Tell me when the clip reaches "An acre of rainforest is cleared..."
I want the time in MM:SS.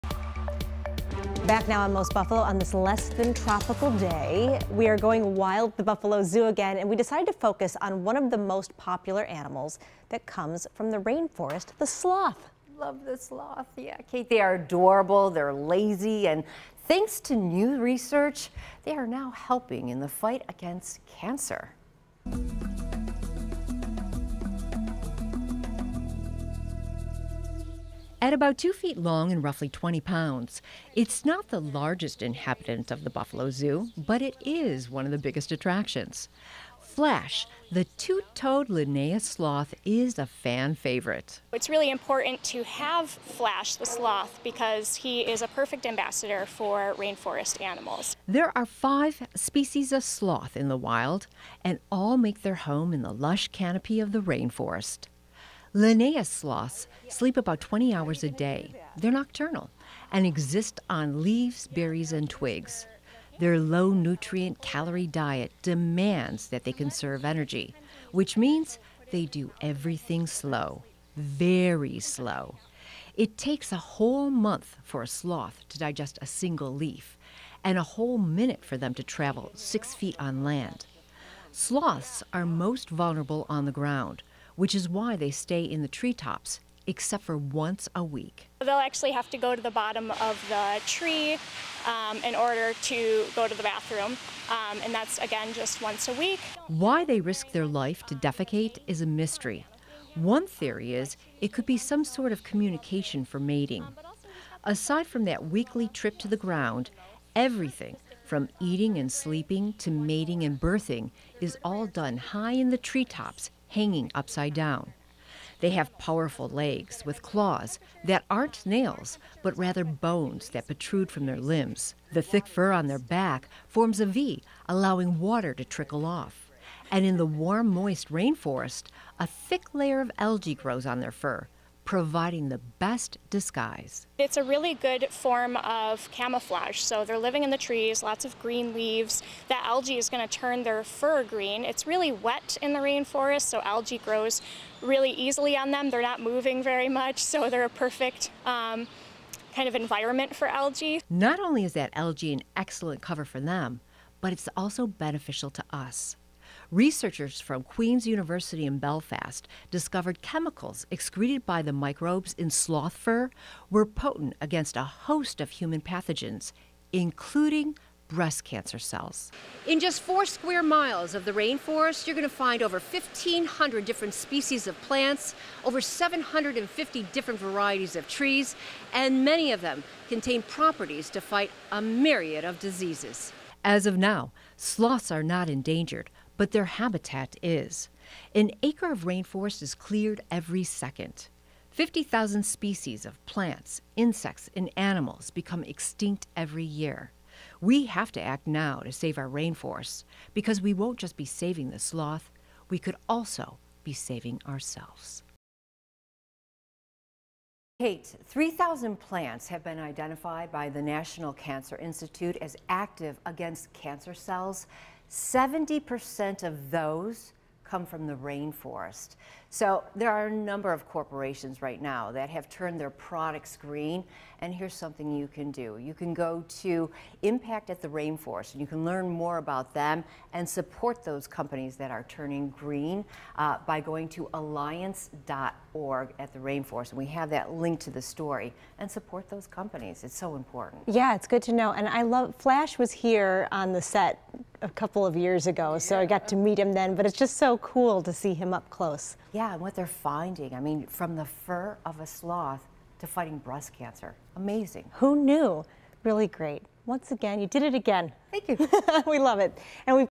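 03:08.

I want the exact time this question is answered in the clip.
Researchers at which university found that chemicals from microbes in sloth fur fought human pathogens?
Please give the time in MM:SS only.
02:37.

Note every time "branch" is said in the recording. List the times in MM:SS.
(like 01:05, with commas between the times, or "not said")
not said.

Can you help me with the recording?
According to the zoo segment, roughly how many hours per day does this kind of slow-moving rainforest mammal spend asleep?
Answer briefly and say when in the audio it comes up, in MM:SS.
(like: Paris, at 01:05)
20, at 00:57.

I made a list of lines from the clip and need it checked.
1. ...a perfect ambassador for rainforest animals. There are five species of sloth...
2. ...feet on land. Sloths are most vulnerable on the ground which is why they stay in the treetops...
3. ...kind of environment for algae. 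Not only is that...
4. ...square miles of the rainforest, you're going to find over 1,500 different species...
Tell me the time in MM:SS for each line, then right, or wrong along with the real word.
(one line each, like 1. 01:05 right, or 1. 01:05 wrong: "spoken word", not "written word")
1. 00:45 right
2. 01:19 right
3. 02:29 right
4. 02:50 right.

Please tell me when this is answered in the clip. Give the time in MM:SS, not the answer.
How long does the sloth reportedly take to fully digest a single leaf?
01:13.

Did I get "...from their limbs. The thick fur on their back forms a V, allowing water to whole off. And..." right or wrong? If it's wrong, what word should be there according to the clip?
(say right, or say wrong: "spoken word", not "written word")
wrong: "trickle", not "whole".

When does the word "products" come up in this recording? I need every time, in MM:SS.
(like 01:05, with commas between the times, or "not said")
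03:42.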